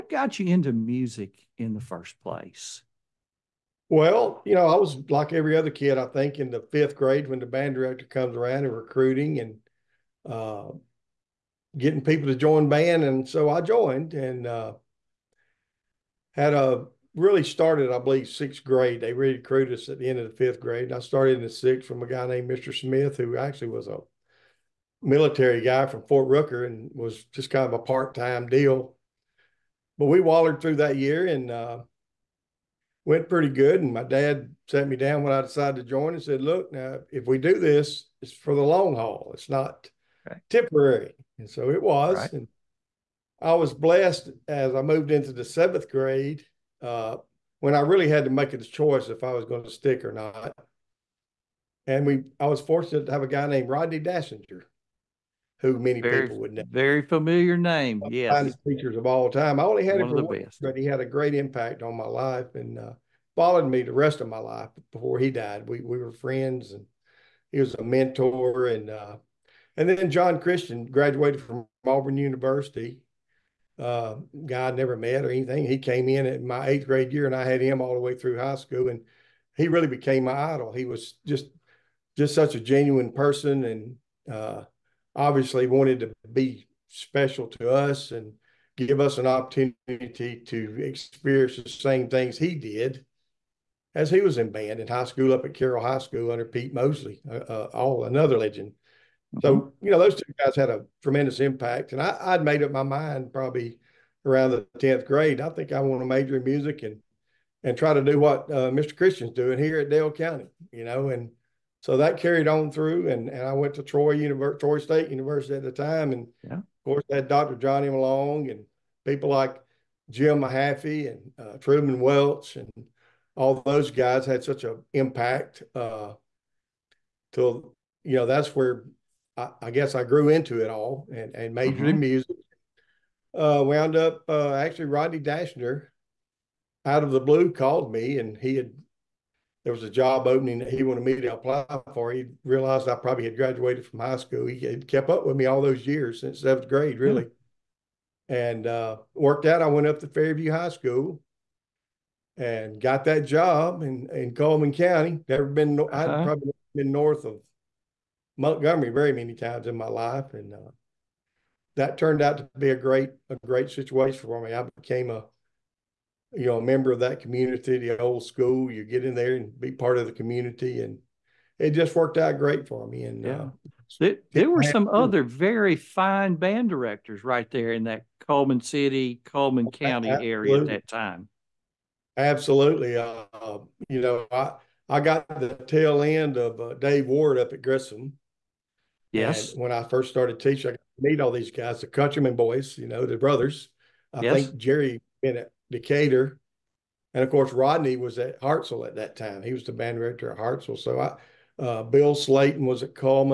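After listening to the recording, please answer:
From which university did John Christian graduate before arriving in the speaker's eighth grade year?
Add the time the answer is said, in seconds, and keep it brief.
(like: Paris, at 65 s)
Auburn University, at 71 s.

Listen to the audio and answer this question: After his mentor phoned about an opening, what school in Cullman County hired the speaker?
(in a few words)
Fairview High School.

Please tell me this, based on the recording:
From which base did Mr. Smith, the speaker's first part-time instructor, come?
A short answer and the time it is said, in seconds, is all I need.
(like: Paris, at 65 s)
Fort Rucker, at 26 s.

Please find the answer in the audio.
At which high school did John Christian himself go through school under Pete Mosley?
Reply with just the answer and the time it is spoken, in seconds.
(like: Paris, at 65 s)
Carroll High School, at 95 s.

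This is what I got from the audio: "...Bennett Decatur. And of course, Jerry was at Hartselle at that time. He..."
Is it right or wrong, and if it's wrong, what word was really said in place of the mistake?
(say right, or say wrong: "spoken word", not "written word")
wrong: "Rodney", not "Jerry".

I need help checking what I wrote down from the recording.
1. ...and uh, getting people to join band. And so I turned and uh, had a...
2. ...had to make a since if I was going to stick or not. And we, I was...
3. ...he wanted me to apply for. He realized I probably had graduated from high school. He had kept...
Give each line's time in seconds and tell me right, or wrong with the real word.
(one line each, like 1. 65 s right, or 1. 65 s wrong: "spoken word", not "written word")
1. 9 s wrong: "joined", not "turned"
2. 48 s wrong: "choice", not "since"
3. 140 s right.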